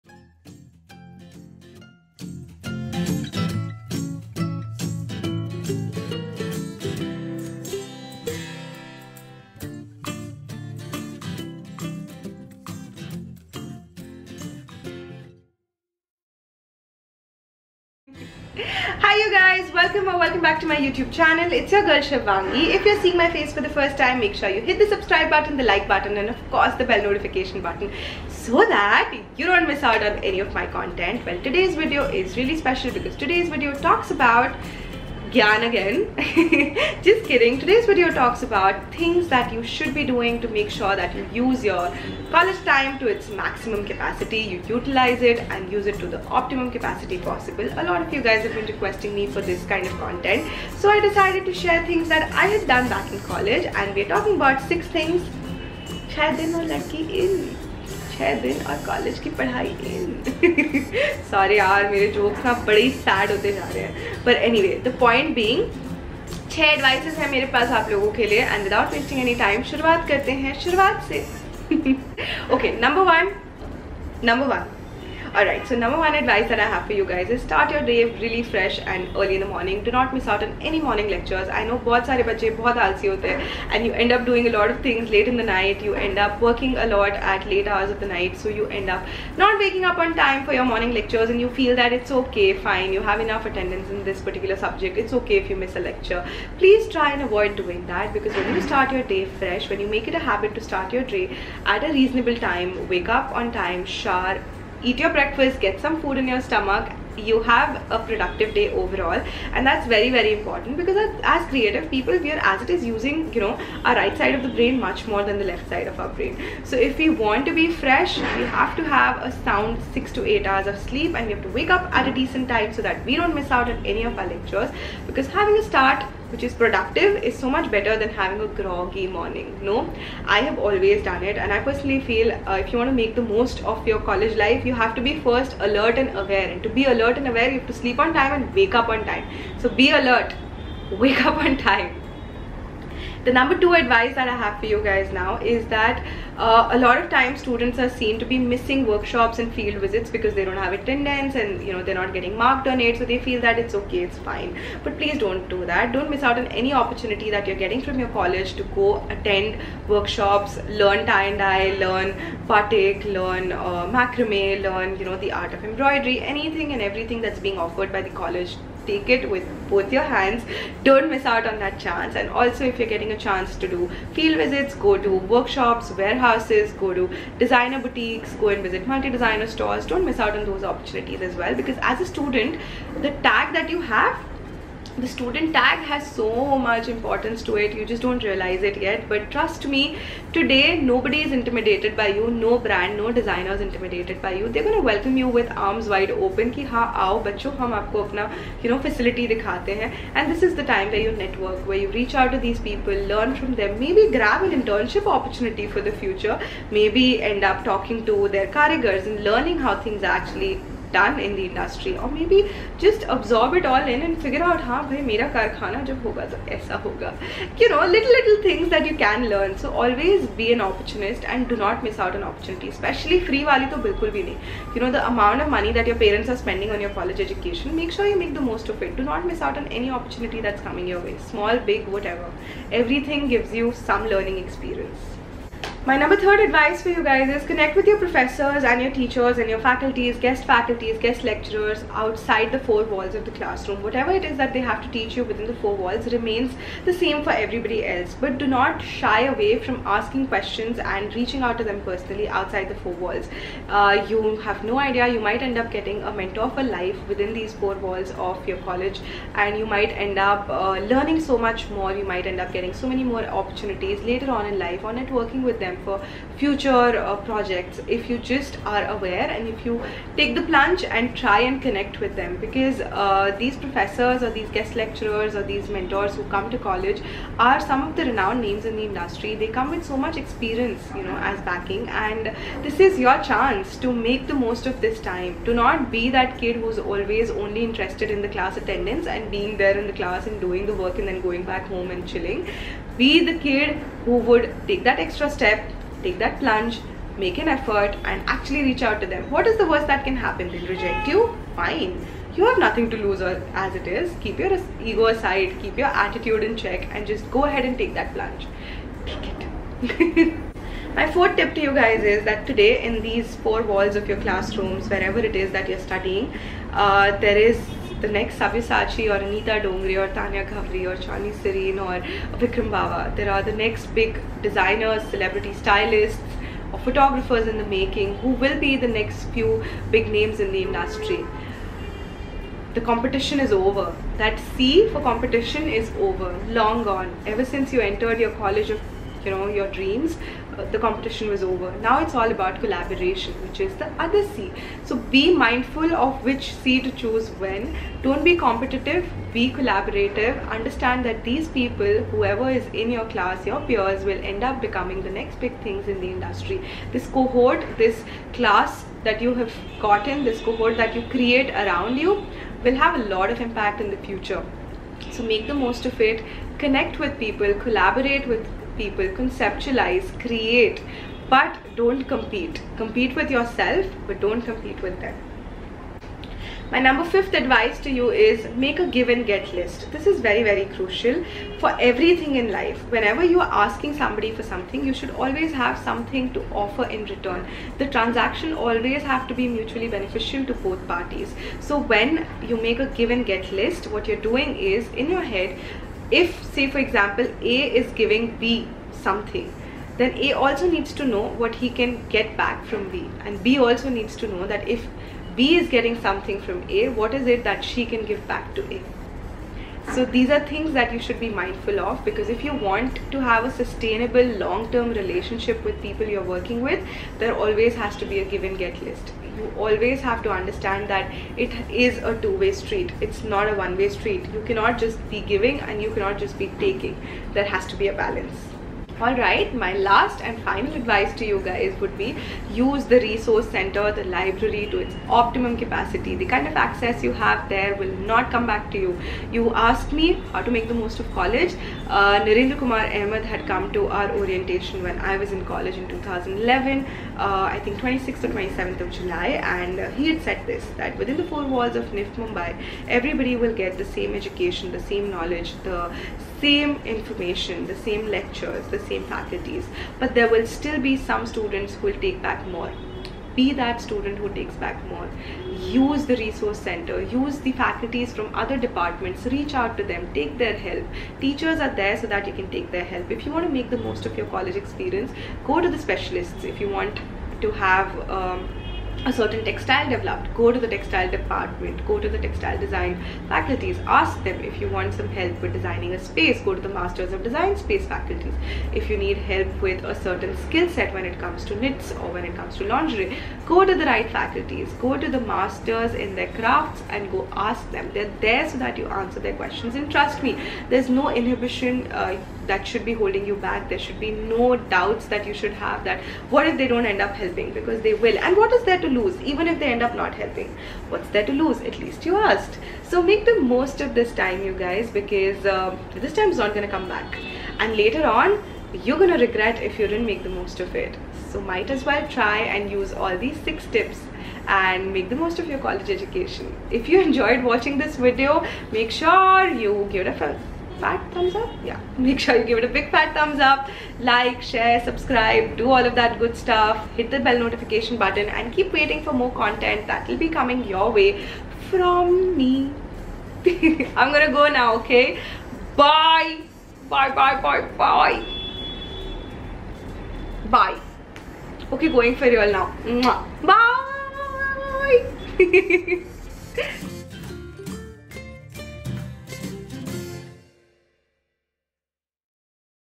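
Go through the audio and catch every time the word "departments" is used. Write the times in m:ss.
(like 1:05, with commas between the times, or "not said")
7:48, 8:01.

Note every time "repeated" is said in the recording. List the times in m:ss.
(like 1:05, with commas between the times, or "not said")
not said.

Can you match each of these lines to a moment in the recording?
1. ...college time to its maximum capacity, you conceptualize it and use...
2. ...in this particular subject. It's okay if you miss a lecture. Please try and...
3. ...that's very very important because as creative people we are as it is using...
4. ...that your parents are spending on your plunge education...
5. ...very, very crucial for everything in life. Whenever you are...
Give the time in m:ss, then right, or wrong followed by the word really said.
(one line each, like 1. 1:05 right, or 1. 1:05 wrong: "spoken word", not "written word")
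1. 0:42 wrong: "utilize", not "conceptualize"
2. 1:33 right
3. 1:49 right
4. 3:45 wrong: "college", not "plunge"
5. 6:20 right.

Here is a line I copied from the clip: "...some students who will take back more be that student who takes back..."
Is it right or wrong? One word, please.
right.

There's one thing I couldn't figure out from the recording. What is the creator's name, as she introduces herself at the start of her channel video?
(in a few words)
Shivangi.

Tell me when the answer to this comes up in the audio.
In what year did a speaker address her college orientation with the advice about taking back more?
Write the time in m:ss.
7:25.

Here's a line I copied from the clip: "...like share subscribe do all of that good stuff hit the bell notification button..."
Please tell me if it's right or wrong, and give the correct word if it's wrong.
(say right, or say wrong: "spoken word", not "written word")
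right.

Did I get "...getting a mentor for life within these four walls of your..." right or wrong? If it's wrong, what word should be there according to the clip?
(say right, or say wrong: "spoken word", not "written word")
right.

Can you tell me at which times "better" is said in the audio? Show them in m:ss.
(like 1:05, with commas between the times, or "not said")
2:07.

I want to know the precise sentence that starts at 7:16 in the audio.
The kind of access you have there will not come back to you.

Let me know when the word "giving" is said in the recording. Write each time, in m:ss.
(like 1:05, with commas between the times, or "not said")
6:37, 7:05.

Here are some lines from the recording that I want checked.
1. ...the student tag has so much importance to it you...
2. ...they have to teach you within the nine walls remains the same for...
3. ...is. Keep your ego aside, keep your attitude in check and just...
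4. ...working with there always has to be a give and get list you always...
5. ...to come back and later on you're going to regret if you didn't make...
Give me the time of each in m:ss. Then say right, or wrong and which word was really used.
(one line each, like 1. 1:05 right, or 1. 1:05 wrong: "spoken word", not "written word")
1. 3:05 right
2. 4:04 wrong: "four", not "nine"
3. 5:03 right
4. 6:56 right
5. 8:36 right.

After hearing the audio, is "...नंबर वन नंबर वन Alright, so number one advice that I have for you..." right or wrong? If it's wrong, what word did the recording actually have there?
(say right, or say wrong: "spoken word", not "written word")
right.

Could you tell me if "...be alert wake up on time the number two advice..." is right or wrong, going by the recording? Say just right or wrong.
right.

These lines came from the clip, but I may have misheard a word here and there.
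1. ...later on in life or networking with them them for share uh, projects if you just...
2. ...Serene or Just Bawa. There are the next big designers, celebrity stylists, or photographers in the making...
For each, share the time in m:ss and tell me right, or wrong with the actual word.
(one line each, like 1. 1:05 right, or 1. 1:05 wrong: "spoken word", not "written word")
1. 4:24 wrong: "future", not "share"
2. 5:21 wrong: "Vikram", not "Just".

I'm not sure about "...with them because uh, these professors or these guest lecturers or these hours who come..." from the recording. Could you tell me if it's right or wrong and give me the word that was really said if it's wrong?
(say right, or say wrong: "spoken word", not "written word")
wrong: "mentors", not "hours".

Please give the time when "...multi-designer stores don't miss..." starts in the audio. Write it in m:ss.
2:58.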